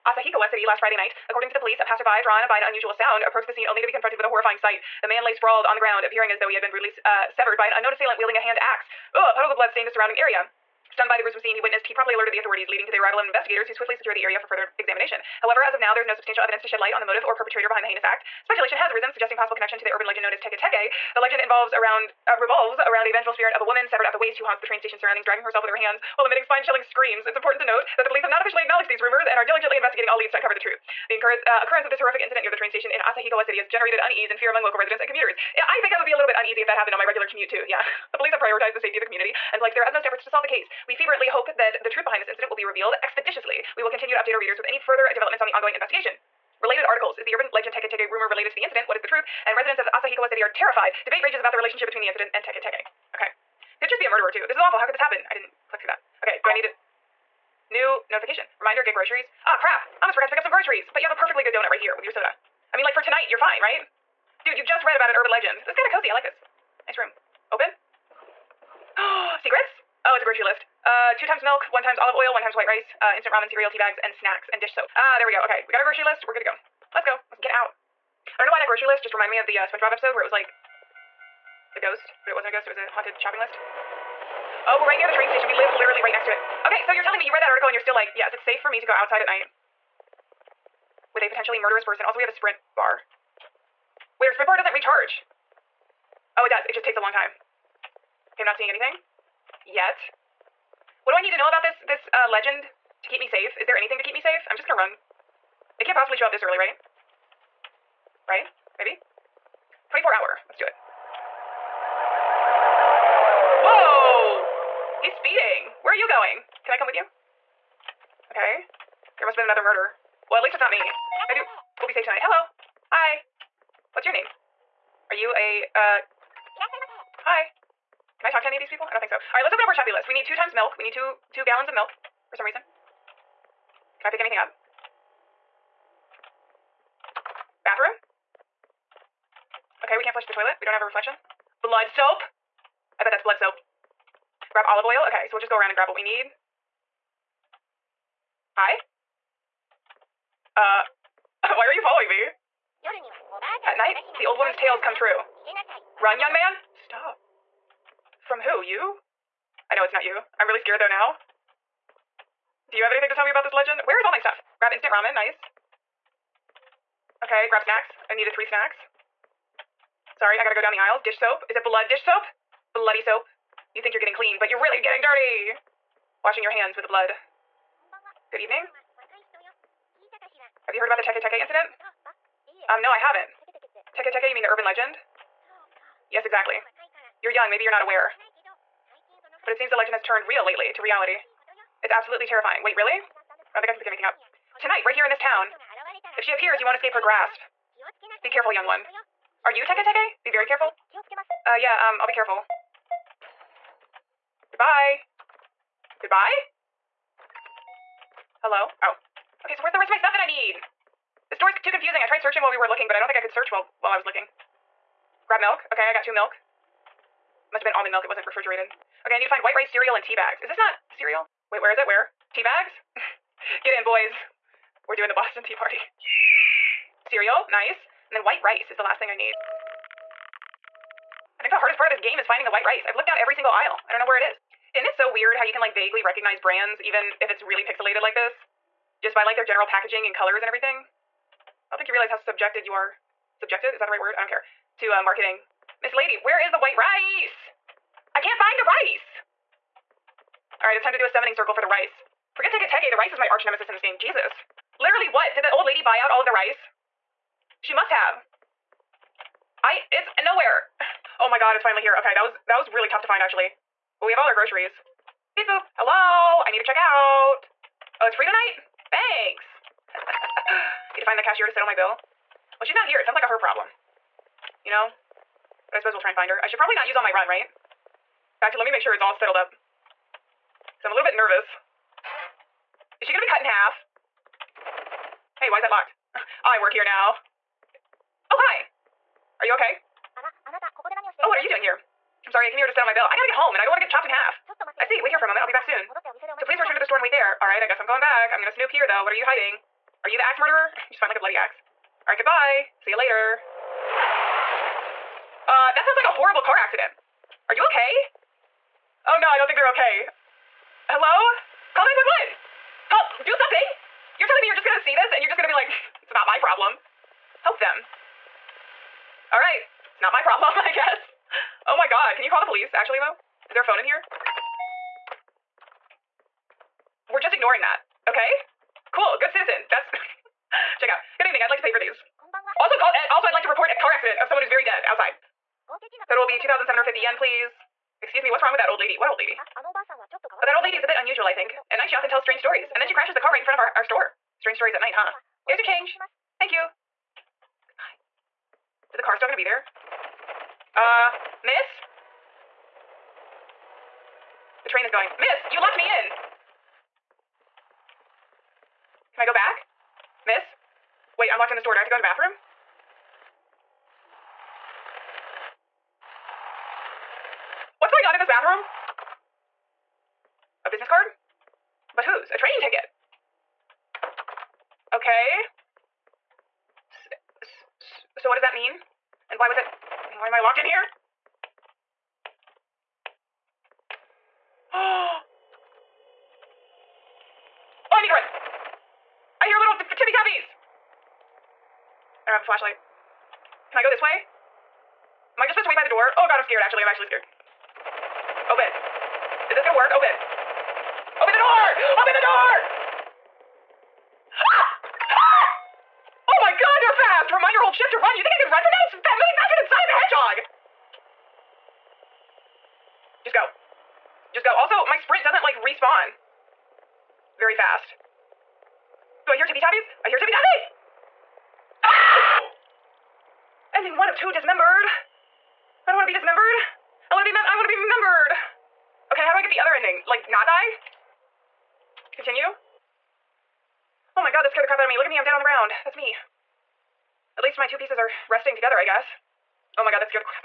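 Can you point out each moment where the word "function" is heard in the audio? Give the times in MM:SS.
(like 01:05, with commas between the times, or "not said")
not said.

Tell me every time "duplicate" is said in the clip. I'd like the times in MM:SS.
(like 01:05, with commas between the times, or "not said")
not said.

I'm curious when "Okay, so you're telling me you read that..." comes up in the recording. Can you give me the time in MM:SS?
01:26.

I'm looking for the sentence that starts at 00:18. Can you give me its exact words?
Speculation has arisen, suggesting possible connection to the urban legend known as Teke Teke.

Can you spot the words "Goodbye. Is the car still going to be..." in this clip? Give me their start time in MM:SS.
05:47.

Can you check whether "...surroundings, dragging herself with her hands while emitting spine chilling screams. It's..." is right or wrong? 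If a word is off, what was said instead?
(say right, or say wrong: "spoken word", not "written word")
right.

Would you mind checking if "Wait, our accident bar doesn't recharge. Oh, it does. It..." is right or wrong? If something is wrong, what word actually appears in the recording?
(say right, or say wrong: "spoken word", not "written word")
wrong: "sprint", not "accident".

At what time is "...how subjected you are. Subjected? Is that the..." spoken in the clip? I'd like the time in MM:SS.
04:02.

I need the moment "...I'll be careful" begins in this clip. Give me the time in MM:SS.
03:21.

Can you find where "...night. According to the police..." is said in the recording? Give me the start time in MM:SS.
00:00.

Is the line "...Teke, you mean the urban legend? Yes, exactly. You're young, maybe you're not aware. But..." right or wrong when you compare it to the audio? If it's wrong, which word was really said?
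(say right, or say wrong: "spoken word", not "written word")
right.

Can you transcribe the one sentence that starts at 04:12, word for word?
Forget Teke Teke, the rice is my arch nemesis in this game.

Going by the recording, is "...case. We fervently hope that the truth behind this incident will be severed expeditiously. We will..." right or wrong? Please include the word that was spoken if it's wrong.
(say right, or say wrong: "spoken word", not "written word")
wrong: "revealed", not "severed".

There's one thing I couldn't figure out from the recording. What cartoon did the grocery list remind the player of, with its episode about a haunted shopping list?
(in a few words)
SpongeBob.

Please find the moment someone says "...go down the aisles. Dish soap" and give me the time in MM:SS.
02:50.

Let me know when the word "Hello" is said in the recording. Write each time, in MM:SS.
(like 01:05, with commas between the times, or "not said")
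02:02, 03:28, 04:25, 05:10.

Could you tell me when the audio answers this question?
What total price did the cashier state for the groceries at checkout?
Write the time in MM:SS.
05:36.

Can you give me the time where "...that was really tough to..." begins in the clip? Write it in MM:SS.
04:22.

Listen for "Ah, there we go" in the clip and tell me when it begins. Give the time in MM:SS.
01:14.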